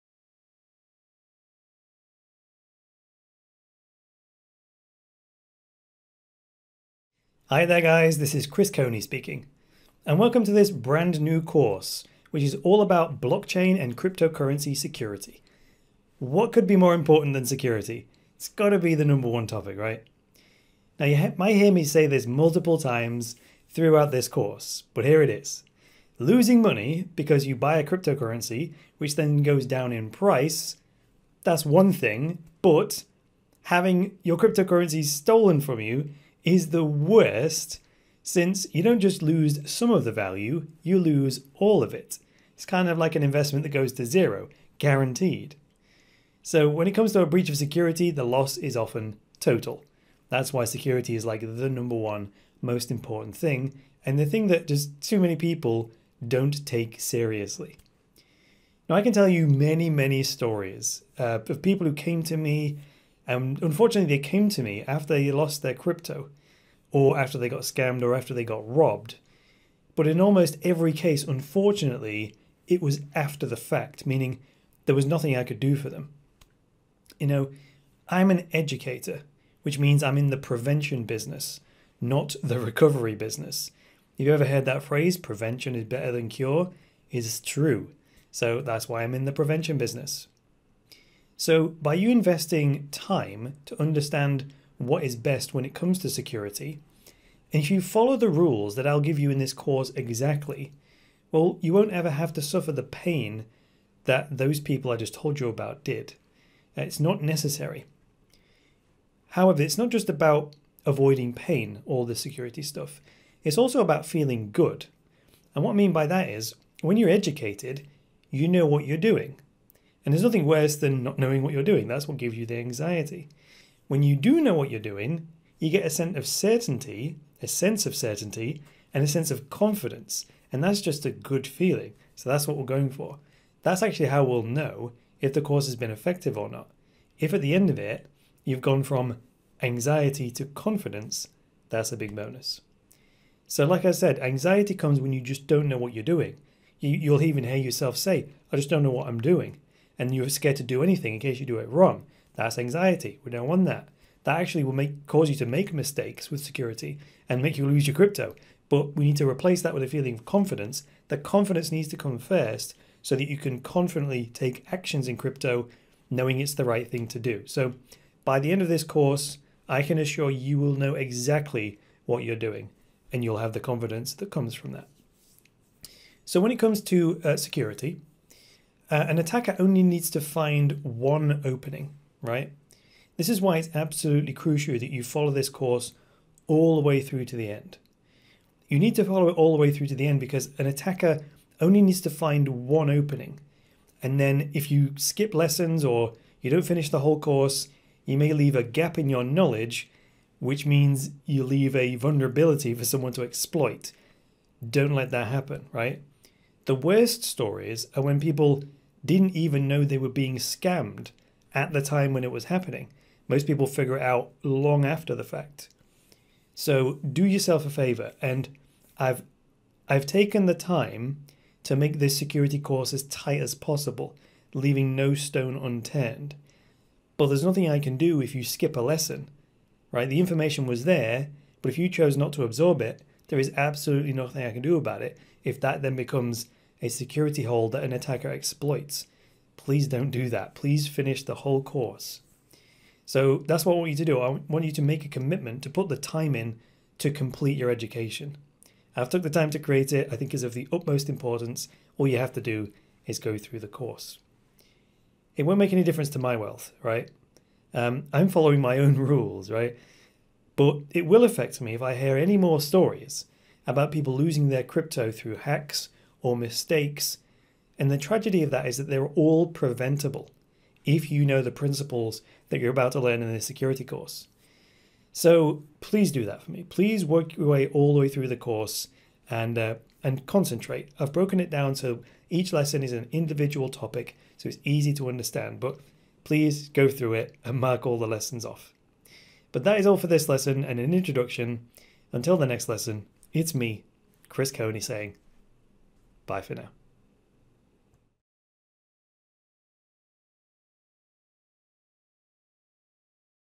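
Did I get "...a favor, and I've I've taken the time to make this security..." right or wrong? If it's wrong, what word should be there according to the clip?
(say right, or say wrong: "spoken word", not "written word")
right.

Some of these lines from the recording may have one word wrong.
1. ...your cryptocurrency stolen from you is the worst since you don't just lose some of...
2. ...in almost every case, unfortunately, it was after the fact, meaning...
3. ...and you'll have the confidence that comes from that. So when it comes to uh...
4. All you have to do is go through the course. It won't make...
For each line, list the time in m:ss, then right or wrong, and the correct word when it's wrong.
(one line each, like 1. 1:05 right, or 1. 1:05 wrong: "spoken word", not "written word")
1. 0:34 right
2. 1:10 right
3. 2:53 right
4. 4:11 right.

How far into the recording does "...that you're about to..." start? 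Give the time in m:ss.
4:32.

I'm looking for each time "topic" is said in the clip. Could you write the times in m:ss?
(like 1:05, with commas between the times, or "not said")
0:19, 4:43.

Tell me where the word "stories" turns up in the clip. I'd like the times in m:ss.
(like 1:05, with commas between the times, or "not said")
1:00, 3:27, 4:22.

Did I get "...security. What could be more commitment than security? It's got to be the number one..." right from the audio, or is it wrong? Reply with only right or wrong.
wrong.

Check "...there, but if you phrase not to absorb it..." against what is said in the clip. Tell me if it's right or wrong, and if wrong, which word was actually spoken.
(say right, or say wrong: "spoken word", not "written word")
wrong: "chose", not "phrase".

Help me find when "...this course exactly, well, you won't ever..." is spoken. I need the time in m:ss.
1:39.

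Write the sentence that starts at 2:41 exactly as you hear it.
The confidence needs to come first so that you can confidently take actions in crypto knowing it's the right thing to do.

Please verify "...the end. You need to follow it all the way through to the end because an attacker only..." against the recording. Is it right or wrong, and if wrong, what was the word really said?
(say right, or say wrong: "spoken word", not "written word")
right.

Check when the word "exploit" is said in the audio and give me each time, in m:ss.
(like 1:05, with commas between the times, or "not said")
3:23, 3:58.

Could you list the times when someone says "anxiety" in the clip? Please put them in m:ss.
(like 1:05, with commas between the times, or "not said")
2:02, 2:19, 2:24, 2:32.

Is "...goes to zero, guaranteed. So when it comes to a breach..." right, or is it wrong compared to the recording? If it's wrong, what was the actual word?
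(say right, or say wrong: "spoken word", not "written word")
right.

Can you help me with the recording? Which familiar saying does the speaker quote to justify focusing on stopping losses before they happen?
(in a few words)
prevention is better than cure.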